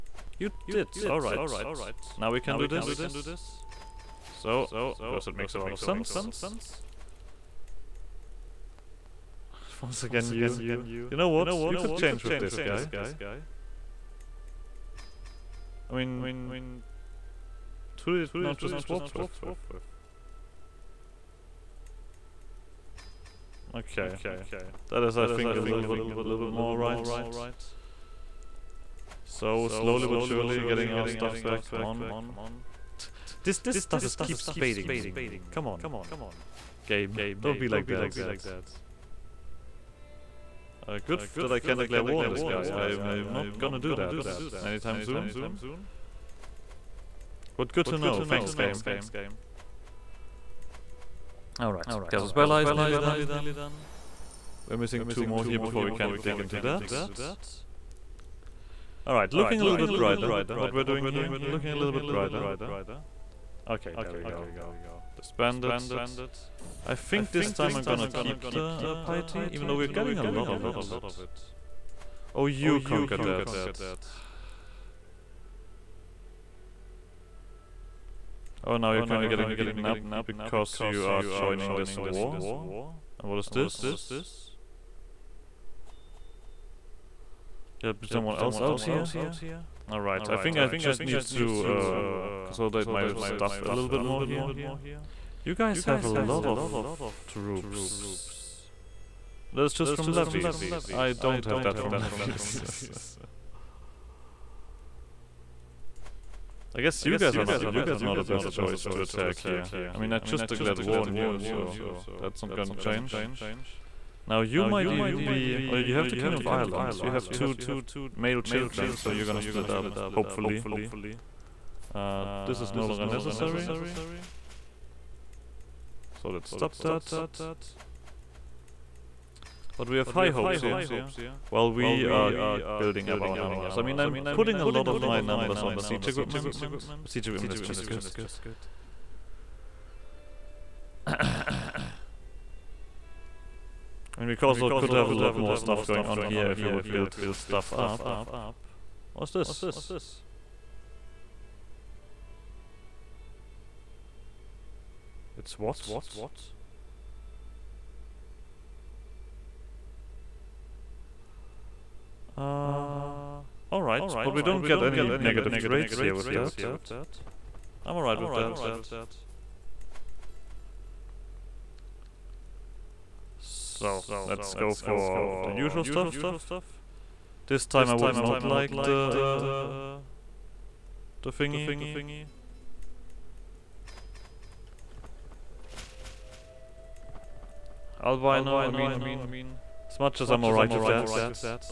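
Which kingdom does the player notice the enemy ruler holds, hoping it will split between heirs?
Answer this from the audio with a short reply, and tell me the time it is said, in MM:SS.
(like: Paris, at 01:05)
Kingdom of Ireland, at 01:56.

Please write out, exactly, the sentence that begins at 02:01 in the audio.
Uh, this is no longer necessary.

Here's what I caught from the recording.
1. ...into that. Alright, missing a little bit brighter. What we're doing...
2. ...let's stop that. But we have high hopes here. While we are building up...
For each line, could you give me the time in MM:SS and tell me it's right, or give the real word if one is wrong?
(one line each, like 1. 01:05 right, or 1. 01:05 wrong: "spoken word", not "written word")
1. 00:56 wrong: "looking", not "missing"
2. 02:06 right.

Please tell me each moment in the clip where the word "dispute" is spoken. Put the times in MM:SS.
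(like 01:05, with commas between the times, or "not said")
not said.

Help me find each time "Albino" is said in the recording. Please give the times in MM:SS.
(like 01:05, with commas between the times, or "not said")
03:08.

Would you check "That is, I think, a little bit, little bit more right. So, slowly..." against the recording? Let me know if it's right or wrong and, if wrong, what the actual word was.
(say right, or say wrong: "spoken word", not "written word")
right.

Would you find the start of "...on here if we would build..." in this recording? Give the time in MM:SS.
02:26.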